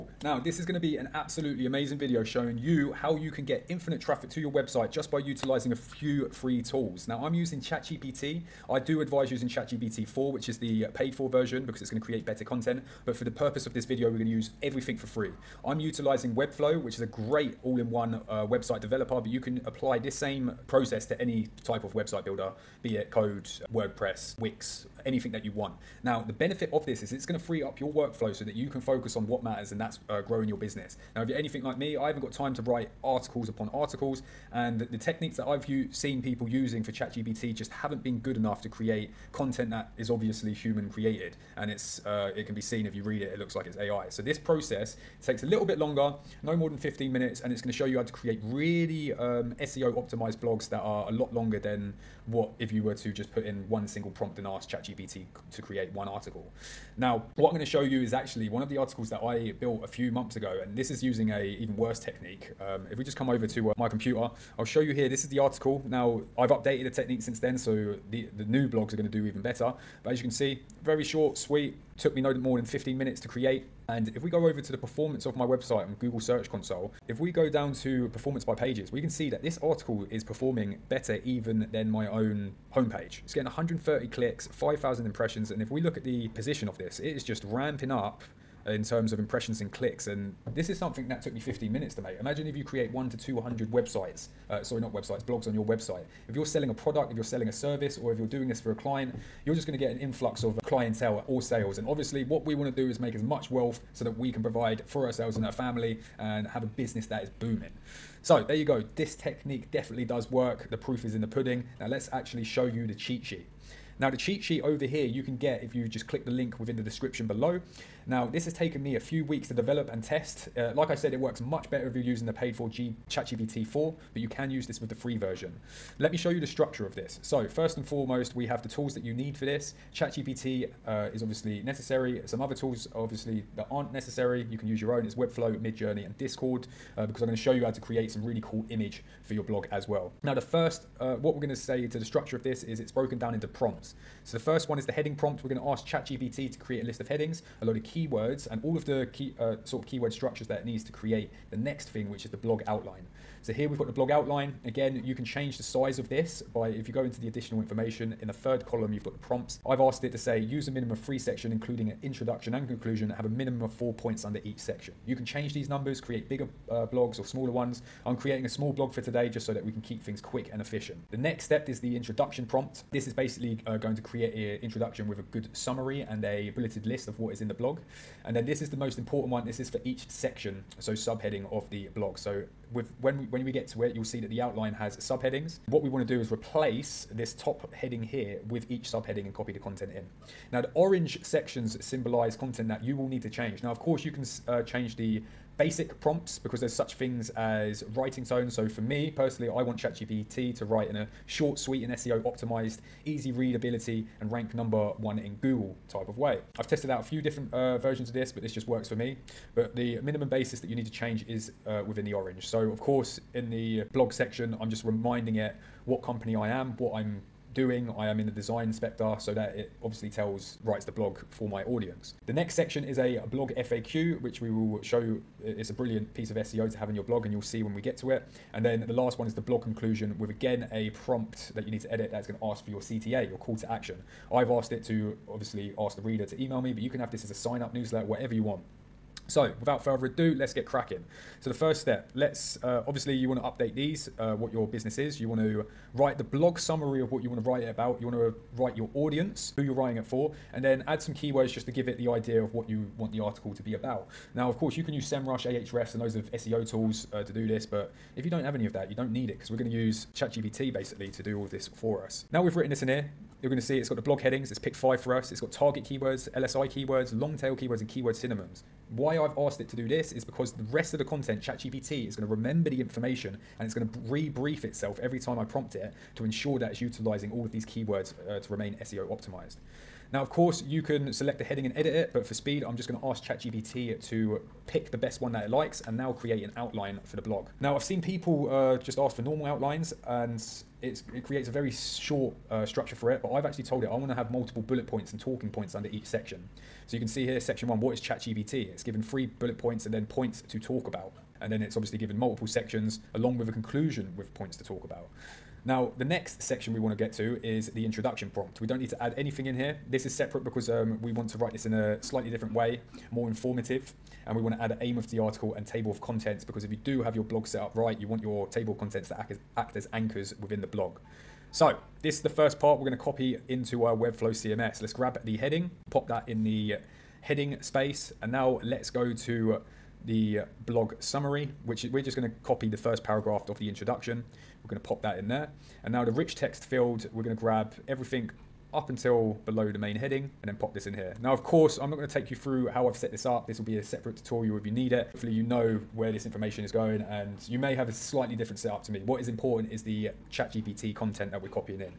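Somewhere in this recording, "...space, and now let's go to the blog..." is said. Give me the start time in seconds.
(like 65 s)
327 s.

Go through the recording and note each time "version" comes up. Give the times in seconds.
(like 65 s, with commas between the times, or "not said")
11 s, 125 s, 207 s.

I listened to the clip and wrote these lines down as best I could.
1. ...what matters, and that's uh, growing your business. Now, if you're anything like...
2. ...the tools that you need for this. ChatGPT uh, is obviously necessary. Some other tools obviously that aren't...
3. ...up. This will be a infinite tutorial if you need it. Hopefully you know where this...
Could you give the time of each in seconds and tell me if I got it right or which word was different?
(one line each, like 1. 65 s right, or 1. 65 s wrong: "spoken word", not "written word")
1. 29 s right
2. 128 s right
3. 343 s wrong: "separate", not "infinite".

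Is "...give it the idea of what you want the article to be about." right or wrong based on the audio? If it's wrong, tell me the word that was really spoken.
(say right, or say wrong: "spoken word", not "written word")
right.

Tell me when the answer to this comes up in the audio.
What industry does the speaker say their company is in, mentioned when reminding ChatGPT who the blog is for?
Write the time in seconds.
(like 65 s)
218 s.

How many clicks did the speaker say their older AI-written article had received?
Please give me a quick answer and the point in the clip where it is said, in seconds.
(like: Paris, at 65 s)
130, at 83 s.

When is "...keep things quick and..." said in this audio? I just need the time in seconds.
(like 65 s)
169 s.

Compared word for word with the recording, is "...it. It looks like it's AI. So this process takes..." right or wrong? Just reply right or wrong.
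right.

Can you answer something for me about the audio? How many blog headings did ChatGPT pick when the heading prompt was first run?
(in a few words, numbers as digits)
5.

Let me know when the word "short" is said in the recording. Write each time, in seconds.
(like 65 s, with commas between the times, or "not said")
71 s, 201 s, 291 s.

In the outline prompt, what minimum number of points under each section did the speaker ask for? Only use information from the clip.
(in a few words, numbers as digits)
4.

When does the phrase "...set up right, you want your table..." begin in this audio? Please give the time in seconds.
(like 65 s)
317 s.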